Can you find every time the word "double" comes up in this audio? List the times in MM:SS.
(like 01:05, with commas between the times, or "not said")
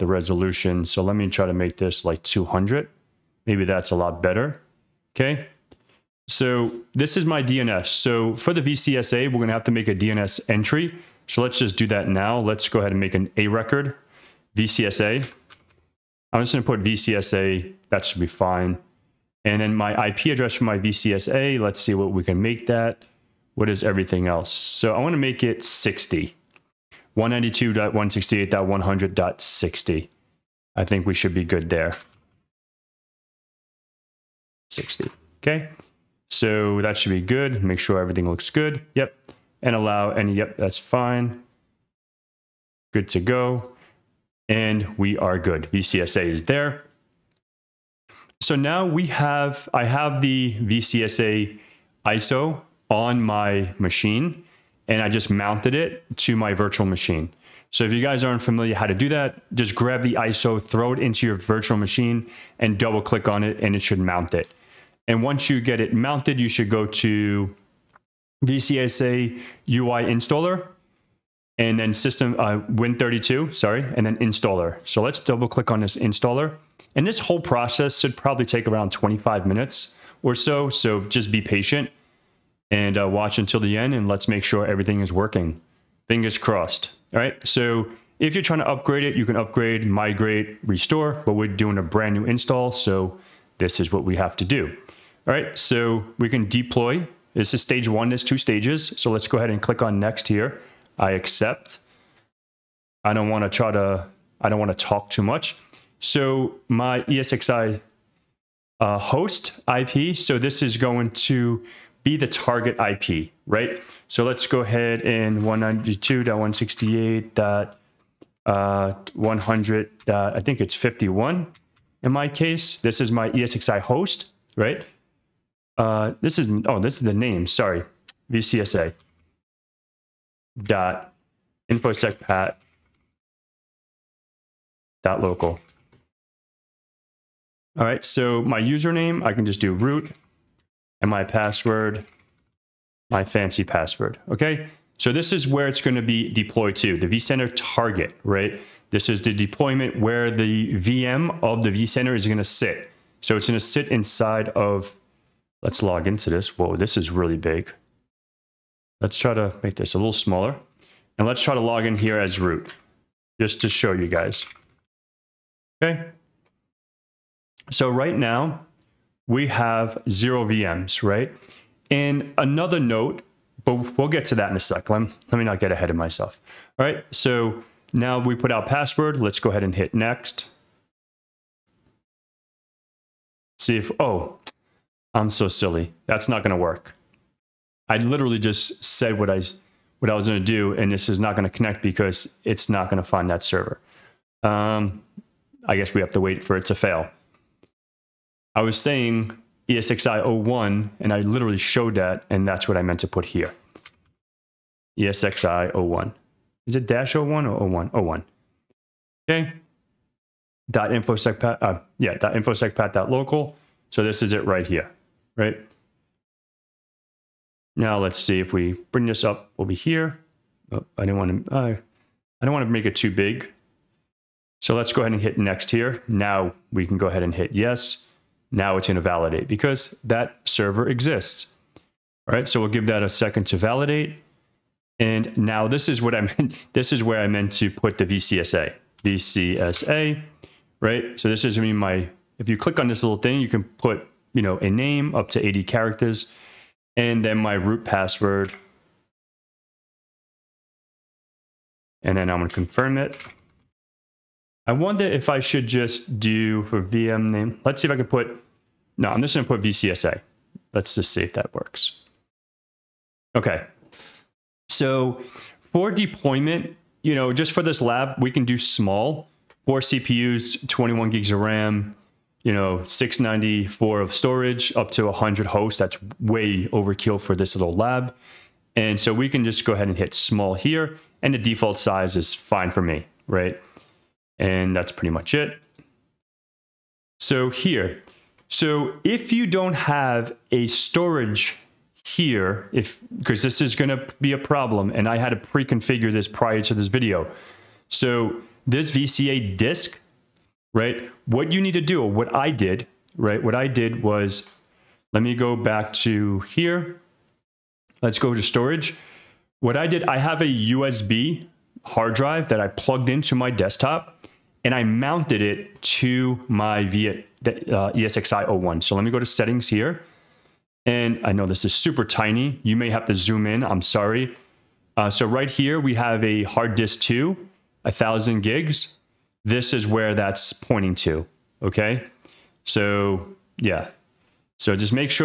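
01:02, 01:15.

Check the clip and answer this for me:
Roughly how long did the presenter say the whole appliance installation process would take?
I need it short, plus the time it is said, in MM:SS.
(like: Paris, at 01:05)
25 minutes, at 01:18.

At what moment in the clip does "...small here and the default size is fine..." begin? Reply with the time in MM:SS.
04:40.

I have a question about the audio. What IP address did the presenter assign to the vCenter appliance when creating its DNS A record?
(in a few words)
192.168.100.60.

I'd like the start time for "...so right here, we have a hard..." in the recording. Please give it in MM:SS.
05:25.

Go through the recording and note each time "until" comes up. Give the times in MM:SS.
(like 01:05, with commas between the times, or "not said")
01:23.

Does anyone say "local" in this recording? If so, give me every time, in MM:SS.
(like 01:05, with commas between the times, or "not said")
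02:15, 03:33.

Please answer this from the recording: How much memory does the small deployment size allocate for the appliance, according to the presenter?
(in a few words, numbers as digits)
21 gigs.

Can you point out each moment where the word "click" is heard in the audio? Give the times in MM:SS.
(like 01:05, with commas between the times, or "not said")
01:03, 01:15, 01:39, 04:02.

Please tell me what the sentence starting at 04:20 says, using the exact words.
Let's just see if that works.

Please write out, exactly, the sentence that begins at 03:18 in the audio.
I was saying ESXi01, and I literally showed that, and that's what I meant to put here.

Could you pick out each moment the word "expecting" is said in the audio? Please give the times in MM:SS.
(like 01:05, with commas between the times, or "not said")
not said.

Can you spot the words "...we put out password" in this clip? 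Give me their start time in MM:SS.
02:58.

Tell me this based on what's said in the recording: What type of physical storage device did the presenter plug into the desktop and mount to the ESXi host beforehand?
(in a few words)
USB hard drive.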